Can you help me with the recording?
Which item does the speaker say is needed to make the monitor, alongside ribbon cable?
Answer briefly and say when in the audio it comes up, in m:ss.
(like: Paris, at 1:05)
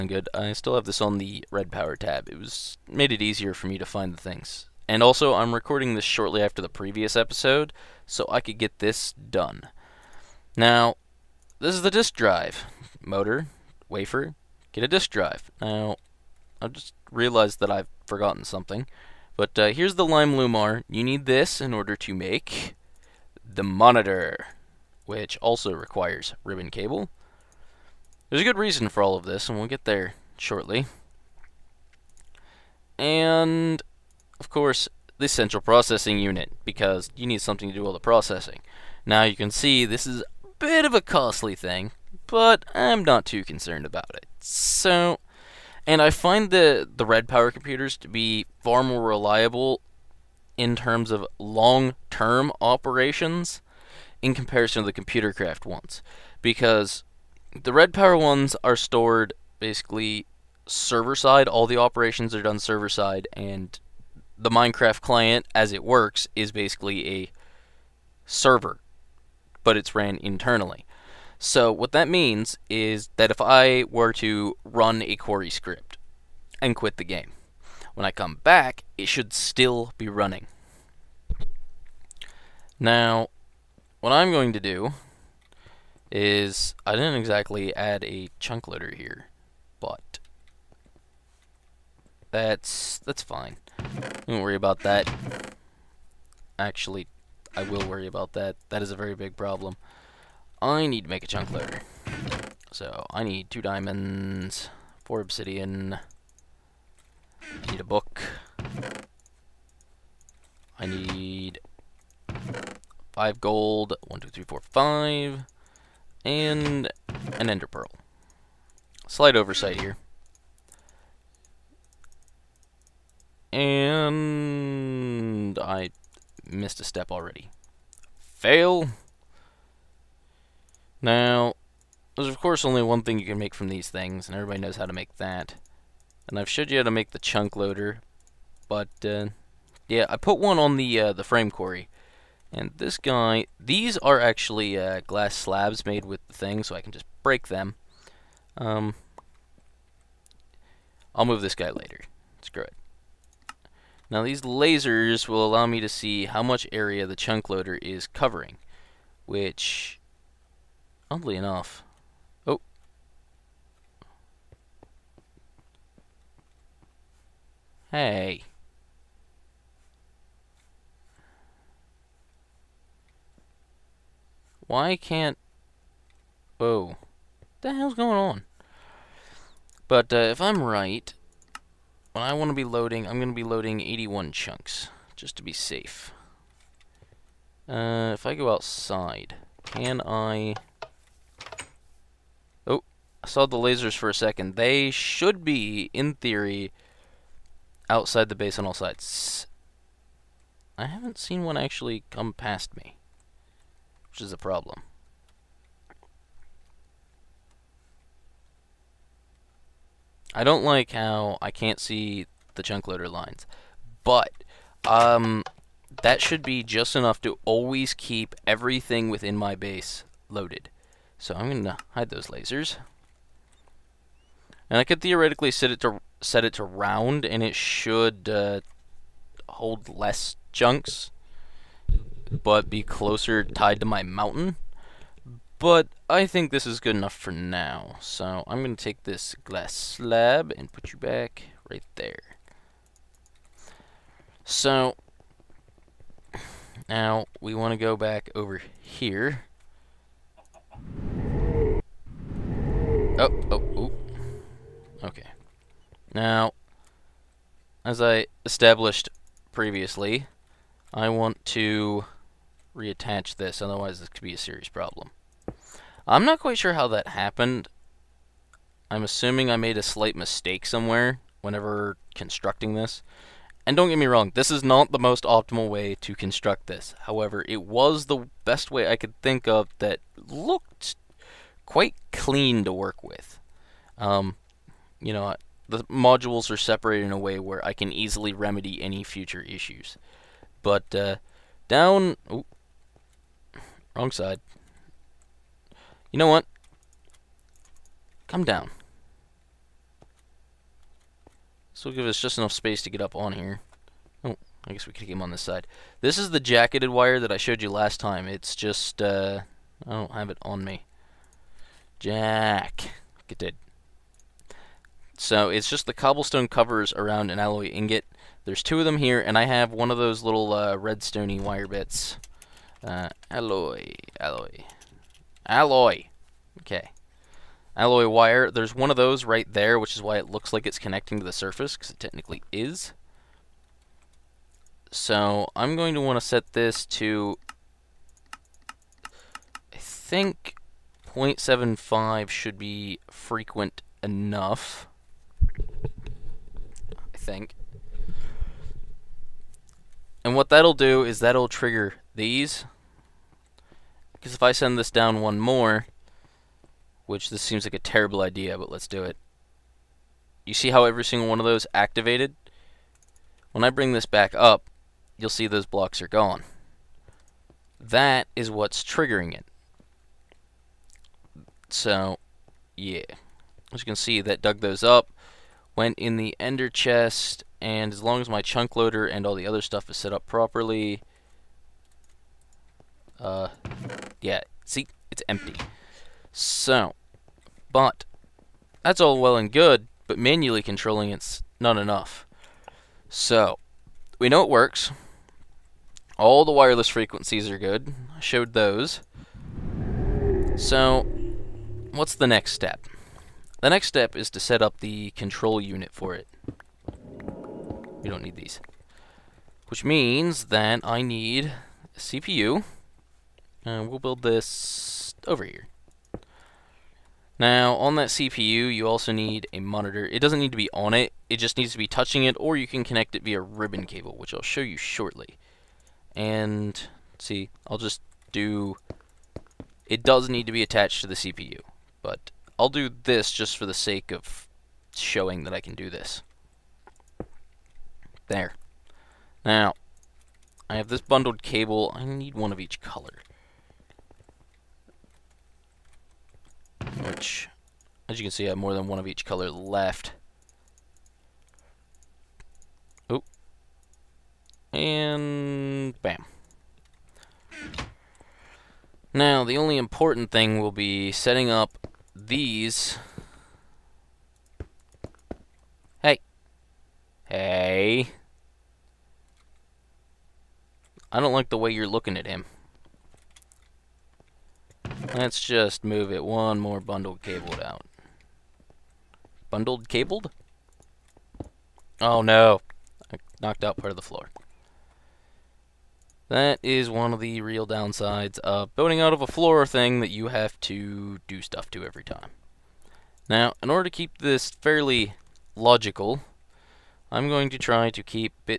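Lime Lumar, at 0:20.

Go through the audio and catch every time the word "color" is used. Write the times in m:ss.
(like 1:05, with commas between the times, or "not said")
7:22, 7:29.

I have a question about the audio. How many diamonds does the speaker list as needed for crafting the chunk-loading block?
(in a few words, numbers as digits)
2.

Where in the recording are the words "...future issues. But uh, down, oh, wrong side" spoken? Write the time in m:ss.
4:49.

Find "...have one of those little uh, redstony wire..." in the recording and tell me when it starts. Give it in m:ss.
5:19.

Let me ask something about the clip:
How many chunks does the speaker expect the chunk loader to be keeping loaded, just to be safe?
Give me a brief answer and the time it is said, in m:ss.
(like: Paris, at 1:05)
81, at 3:03.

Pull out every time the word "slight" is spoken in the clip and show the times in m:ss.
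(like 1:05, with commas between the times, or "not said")
1:59, 4:29.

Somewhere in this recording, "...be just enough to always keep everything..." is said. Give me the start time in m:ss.
3:36.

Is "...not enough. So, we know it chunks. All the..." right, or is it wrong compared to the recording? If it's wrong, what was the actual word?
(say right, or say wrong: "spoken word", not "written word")
wrong: "works", not "chunks".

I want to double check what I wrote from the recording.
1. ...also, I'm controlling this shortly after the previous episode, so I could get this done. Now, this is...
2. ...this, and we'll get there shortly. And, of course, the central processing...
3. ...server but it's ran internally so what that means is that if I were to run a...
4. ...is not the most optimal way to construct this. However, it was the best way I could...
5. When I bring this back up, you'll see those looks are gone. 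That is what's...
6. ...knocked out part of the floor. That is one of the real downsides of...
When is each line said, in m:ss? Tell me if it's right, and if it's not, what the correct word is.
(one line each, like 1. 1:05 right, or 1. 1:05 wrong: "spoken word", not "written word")
1. 0:05 wrong: "recording", not "controlling"
2. 0:29 right
3. 1:08 right
4. 4:34 right
5. 6:03 wrong: "blocks", not "looks"
6. 8:03 right.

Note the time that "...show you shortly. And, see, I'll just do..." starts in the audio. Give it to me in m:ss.
7:04.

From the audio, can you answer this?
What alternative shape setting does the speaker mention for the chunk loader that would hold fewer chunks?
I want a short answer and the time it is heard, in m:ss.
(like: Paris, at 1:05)
Round, at 3:46.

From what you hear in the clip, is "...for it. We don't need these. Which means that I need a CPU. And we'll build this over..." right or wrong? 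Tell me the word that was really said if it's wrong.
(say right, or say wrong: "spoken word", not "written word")
right.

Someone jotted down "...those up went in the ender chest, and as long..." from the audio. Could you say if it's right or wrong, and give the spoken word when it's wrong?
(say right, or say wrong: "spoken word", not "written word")
right.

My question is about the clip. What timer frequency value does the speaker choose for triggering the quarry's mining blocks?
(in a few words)
0.75.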